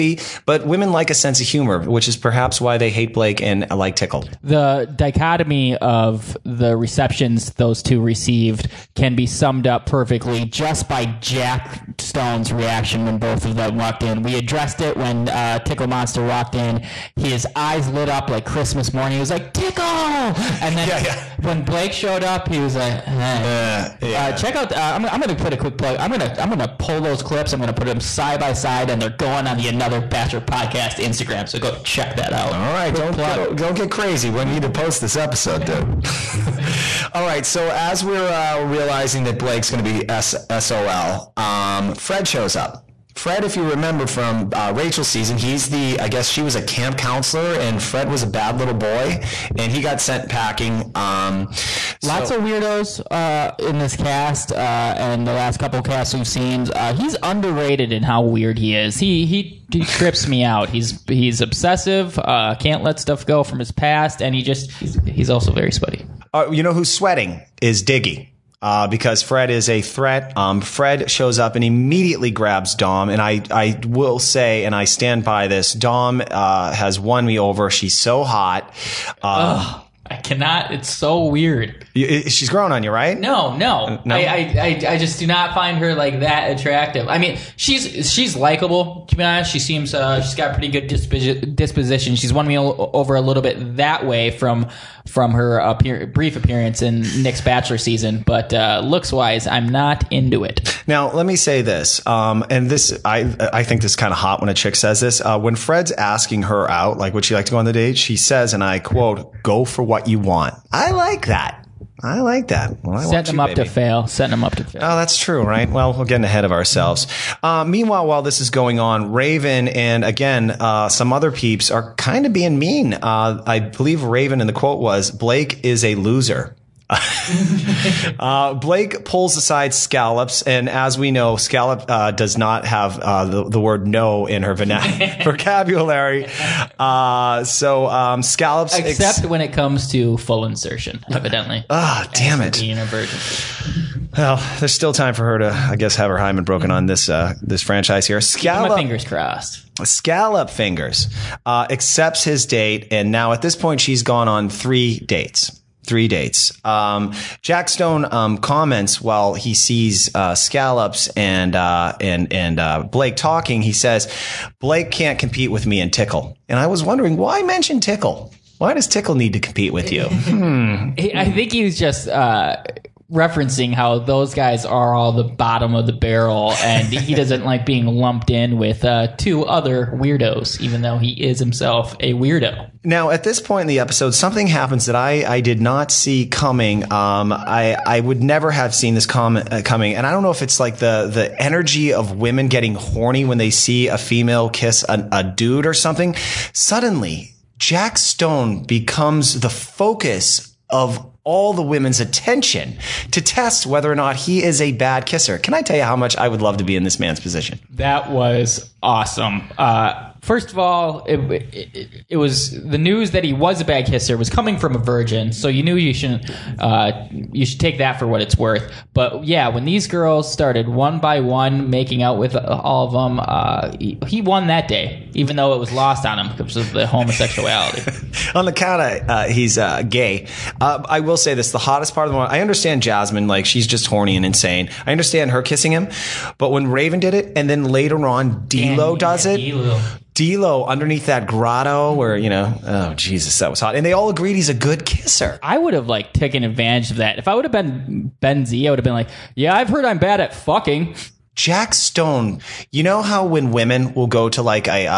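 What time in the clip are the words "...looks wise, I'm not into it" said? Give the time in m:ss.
1:38.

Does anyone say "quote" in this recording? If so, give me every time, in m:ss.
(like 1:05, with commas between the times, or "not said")
1:48, 2:04.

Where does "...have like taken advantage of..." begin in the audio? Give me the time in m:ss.
4:05.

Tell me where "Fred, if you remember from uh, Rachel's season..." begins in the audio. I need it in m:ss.
0:43.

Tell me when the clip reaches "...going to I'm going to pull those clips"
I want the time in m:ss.
0:26.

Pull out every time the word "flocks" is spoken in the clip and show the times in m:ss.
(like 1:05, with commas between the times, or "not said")
not said.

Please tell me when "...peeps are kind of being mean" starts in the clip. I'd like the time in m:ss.
2:01.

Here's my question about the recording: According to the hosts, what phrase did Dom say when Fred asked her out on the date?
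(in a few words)
Go for what you want.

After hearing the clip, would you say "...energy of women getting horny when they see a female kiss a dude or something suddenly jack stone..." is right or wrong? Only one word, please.
right.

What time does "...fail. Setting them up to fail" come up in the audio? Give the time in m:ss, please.
1:53.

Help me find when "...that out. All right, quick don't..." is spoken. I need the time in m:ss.
0:32.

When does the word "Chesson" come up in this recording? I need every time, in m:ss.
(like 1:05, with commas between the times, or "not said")
not said.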